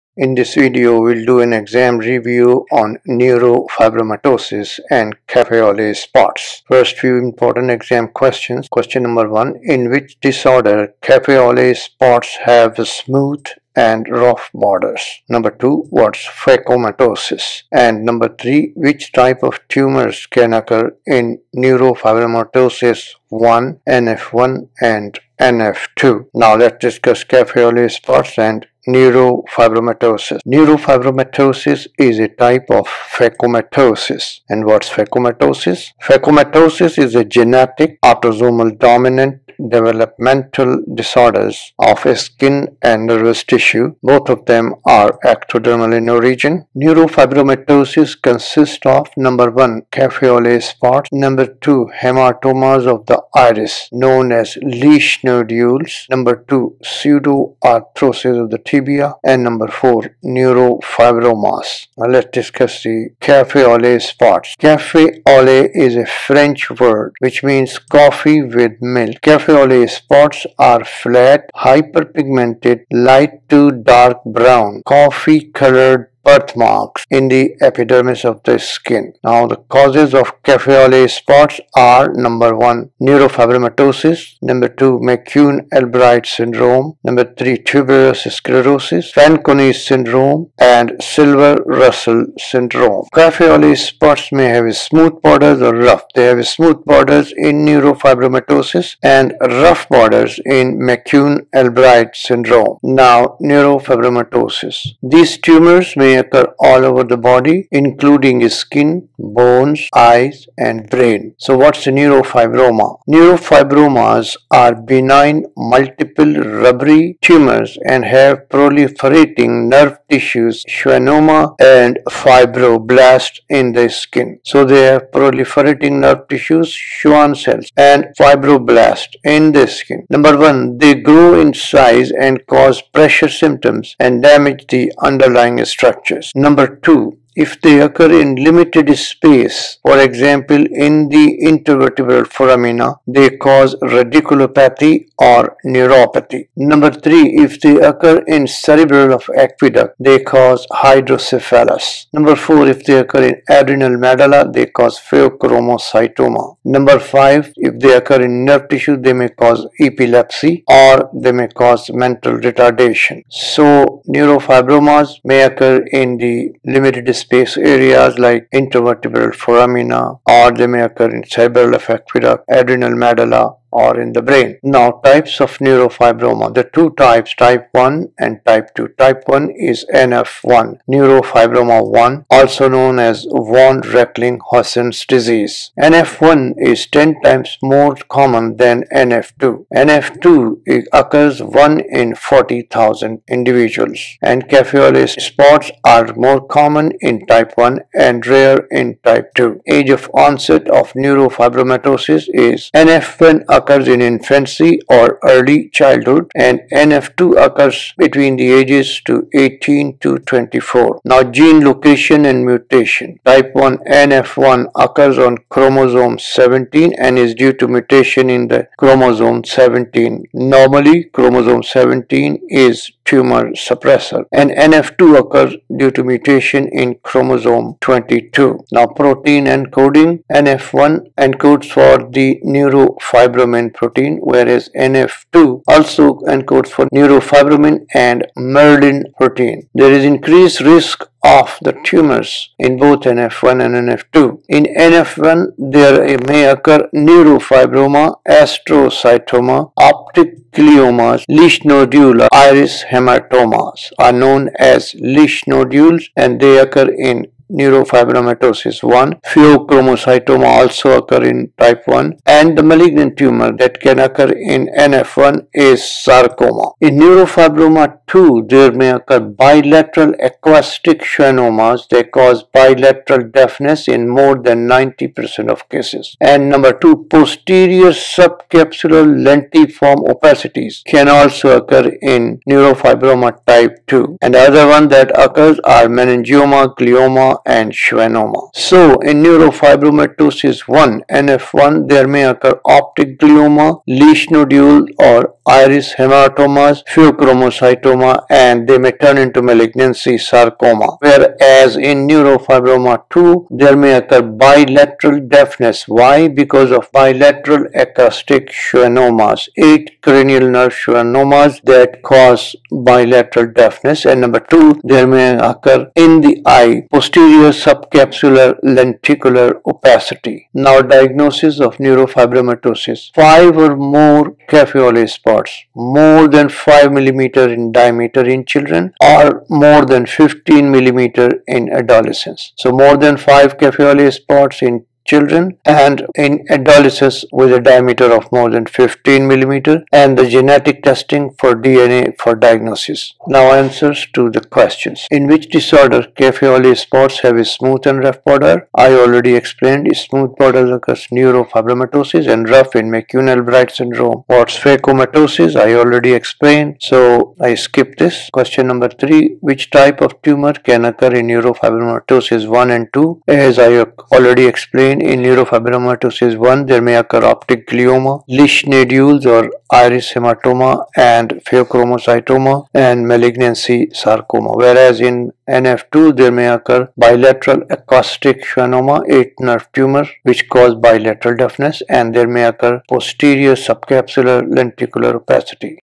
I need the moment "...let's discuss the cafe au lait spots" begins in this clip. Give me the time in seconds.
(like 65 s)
62 s.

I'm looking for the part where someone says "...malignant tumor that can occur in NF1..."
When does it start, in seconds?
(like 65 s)
262 s.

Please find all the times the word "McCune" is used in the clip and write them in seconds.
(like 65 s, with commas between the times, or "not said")
84 s, 100 s, 352 s.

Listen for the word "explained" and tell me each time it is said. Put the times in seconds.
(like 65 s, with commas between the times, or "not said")
349 s, 356 s, 364 s.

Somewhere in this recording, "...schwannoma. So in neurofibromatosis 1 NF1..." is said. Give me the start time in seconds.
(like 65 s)
287 s.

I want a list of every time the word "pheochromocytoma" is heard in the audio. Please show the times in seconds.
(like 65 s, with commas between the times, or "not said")
154 s, 259 s, 296 s, 371 s.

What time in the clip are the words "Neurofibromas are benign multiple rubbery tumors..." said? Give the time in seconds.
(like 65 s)
113 s.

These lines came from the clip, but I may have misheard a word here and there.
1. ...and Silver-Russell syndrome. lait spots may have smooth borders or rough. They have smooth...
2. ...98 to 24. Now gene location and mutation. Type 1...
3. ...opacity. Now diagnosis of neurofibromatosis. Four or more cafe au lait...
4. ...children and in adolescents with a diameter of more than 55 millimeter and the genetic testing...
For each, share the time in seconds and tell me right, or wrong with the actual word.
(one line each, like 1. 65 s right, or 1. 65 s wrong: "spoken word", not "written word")
1. 90 s right
2. 209 s wrong: "18", not "98"
3. 319 s wrong: "Five", not "Four"
4. 335 s wrong: "15", not "55".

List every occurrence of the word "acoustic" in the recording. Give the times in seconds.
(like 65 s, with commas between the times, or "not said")
270 s, 307 s, 377 s.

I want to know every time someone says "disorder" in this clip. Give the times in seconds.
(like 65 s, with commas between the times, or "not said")
10 s, 40 s, 345 s.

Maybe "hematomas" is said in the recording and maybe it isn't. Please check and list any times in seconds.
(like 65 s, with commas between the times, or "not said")
52 s, 252 s, 295 s, 370 s.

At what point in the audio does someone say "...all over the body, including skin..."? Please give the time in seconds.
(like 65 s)
106 s.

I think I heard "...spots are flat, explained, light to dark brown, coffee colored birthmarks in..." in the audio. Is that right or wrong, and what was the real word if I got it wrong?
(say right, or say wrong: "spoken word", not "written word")
wrong: "hyperpigmented", not "explained".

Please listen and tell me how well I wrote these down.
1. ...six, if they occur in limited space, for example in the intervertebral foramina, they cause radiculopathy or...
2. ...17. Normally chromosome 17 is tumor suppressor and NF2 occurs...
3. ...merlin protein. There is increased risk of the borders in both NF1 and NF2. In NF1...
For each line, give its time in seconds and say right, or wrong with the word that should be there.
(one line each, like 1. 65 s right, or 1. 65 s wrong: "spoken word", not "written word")
1. 136 s wrong: "two", not "six"
2. 219 s right
3. 238 s wrong: "tumors", not "borders".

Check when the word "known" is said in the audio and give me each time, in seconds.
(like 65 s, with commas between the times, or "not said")
53 s, 182 s, 254 s.